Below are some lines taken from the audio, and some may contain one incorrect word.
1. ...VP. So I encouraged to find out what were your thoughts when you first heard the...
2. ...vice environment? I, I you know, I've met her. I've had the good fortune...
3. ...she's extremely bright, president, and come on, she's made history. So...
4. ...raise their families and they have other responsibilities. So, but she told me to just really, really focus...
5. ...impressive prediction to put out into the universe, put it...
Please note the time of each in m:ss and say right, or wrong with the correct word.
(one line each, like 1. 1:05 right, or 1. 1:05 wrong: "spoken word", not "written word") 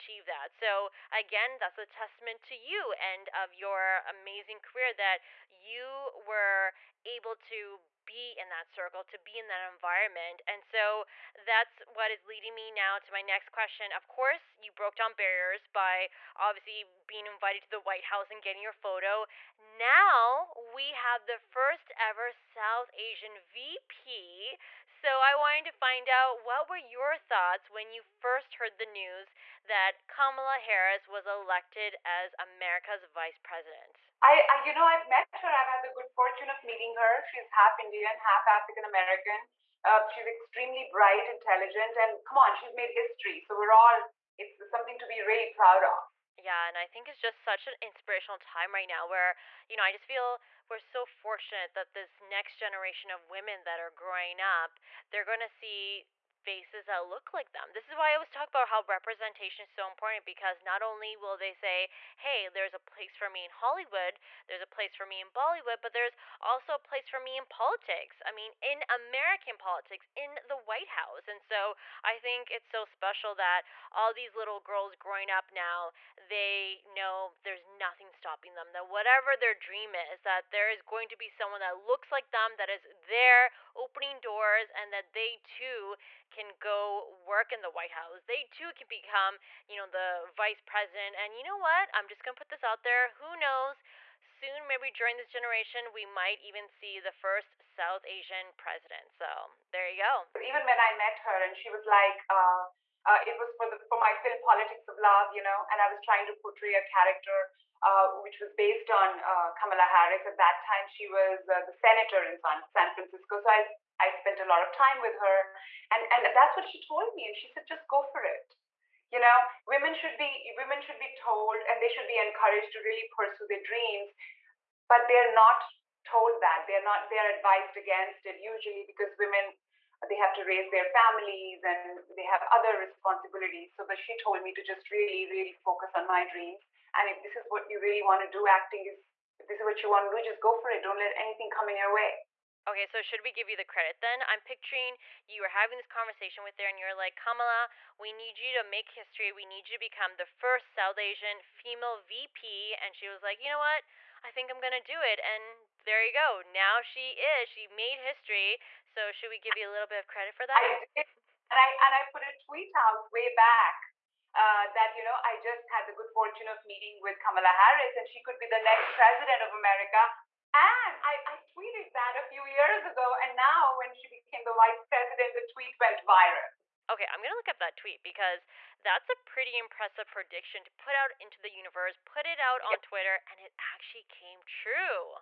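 1. 0:23 wrong: "wanted", not "encouraged"
2. 0:33 wrong: "president", not "environment"
3. 0:40 wrong: "intelligent", not "president"
4. 2:10 right
5. 2:59 right.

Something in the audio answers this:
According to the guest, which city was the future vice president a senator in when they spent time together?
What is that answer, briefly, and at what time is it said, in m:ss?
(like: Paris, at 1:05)
San Francisco, at 1:52.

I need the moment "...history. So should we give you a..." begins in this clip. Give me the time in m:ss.
2:37.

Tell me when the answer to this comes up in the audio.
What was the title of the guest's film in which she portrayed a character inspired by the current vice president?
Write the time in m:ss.
1:44.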